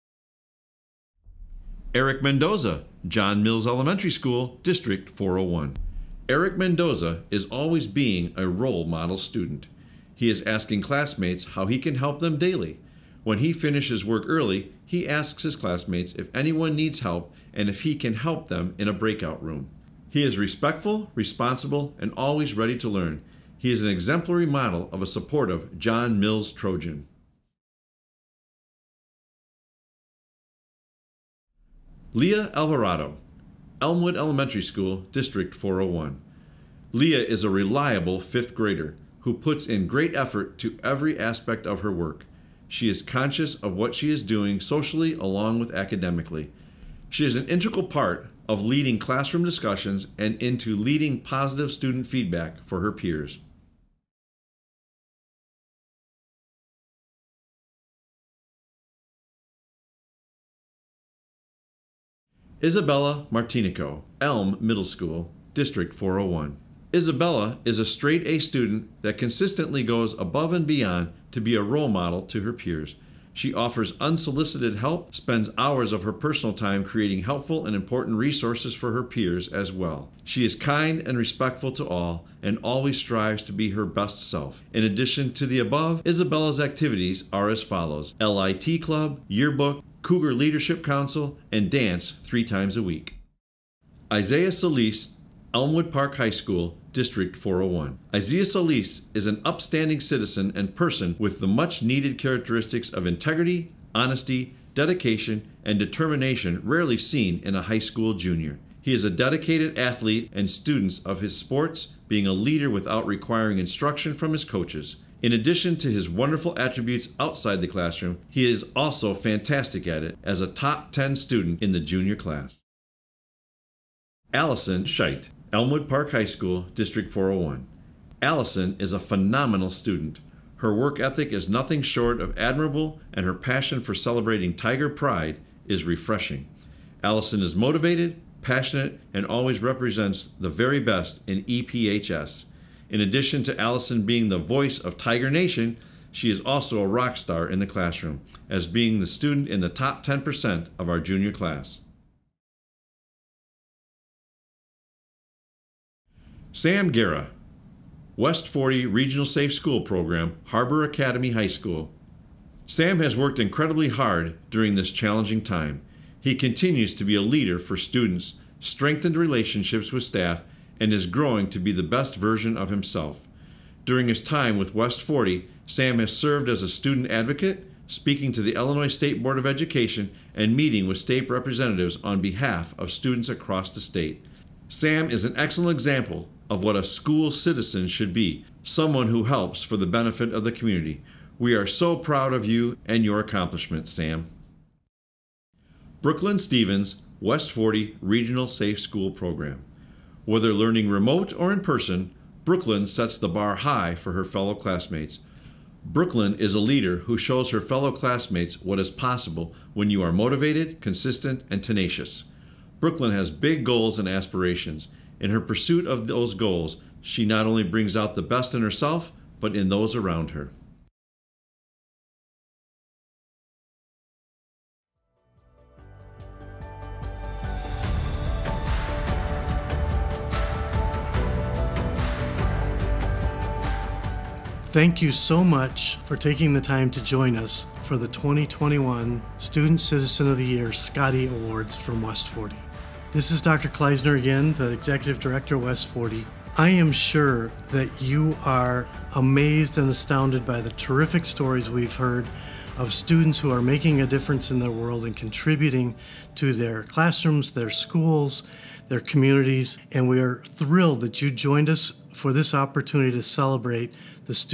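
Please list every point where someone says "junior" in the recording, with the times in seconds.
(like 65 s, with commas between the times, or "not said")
108 s, 121 s, 150 s.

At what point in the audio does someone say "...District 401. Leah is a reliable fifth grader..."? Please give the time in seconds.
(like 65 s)
35 s.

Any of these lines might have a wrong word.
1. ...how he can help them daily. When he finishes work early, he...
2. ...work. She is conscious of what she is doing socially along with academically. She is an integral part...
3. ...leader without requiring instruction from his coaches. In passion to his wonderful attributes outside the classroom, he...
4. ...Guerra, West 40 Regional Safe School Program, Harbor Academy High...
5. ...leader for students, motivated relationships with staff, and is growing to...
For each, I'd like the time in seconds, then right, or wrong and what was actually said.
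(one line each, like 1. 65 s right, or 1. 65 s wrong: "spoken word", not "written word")
1. 11 s right
2. 41 s right
3. 112 s wrong: "addition", not "passion"
4. 156 s right
5. 167 s wrong: "strengthened", not "motivated".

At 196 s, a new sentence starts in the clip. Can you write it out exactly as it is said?
Brooklyn Stevens, West 40 Regional Safe School Program.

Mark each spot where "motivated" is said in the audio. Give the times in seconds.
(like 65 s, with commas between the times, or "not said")
137 s, 210 s.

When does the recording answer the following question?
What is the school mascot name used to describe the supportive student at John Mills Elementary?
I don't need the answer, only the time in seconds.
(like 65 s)
26 s.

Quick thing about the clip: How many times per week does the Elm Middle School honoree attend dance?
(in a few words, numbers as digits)
3.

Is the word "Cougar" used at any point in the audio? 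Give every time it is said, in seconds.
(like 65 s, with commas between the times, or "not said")
90 s.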